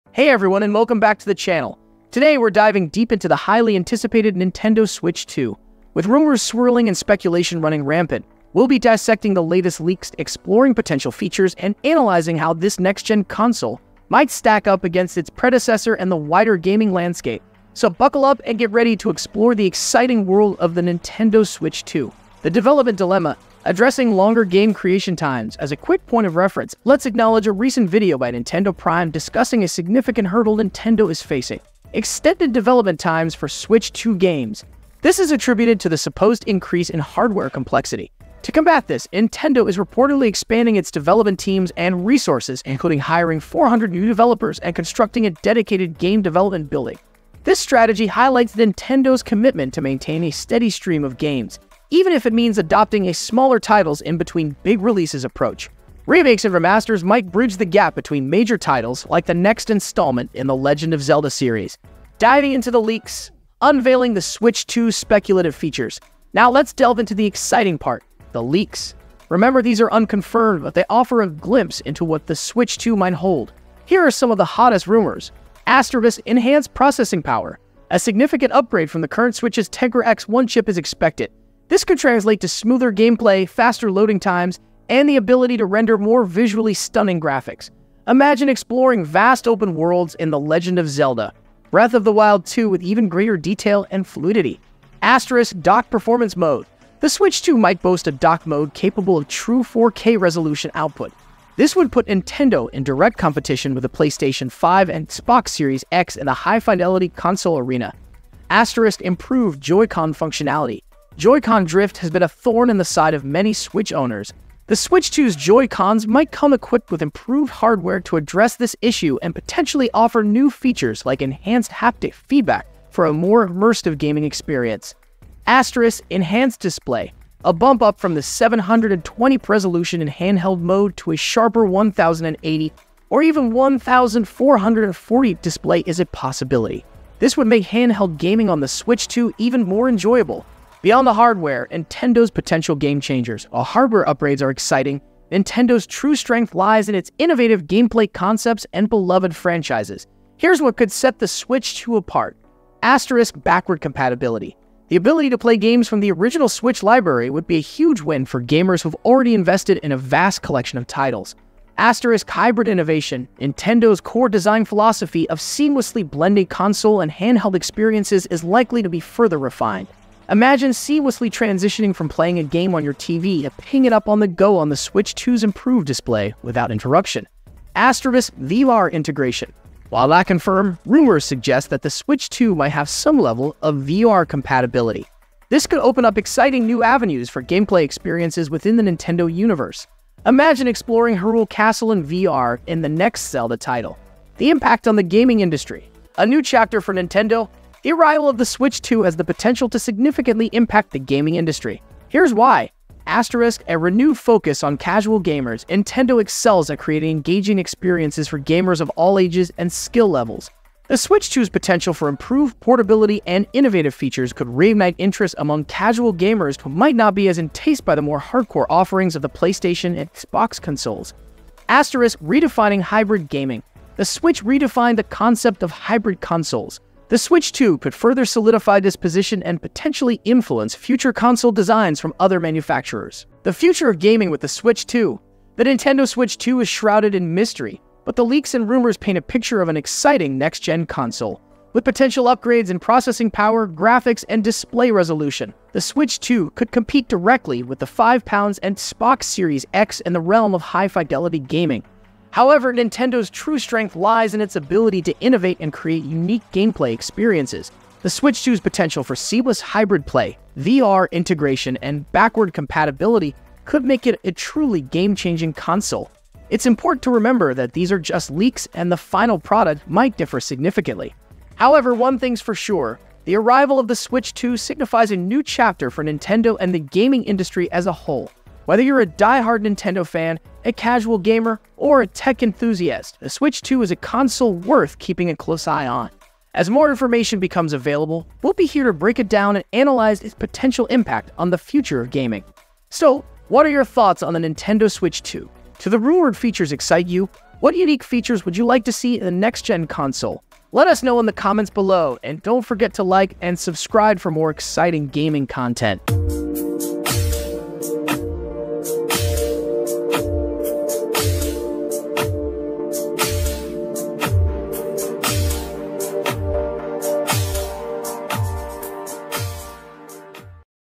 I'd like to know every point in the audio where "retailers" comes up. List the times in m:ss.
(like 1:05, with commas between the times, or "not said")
not said.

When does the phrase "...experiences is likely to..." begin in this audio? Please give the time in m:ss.
2:47.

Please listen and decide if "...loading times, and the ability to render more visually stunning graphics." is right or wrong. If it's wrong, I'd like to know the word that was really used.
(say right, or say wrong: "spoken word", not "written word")
right.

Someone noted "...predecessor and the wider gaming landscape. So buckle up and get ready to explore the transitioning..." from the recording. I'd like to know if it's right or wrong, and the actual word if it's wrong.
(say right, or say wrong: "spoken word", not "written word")
wrong: "exciting", not "transitioning".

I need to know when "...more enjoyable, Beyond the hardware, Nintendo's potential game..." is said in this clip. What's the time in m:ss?
2:19.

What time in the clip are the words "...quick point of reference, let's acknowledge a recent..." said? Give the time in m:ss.
0:25.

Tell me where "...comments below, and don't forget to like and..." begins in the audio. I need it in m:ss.
5:01.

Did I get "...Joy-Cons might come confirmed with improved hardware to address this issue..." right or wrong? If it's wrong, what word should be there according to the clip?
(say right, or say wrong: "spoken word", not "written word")
wrong: "equipped", not "confirmed".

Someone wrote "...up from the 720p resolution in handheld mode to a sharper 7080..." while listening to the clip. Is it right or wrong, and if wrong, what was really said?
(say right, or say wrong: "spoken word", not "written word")
wrong: "1080", not "7080".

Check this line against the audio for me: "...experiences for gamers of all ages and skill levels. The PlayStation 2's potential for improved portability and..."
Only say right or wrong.
wrong.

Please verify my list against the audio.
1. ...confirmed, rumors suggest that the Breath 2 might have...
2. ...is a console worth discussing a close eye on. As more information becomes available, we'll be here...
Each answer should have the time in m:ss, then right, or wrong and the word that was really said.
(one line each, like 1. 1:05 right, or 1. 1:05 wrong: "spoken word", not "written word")
1. 3:00 wrong: "Switch", not "Breath"
2. 4:43 wrong: "keeping", not "discussing".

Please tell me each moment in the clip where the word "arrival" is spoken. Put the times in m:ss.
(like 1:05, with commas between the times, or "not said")
3:17, 4:33.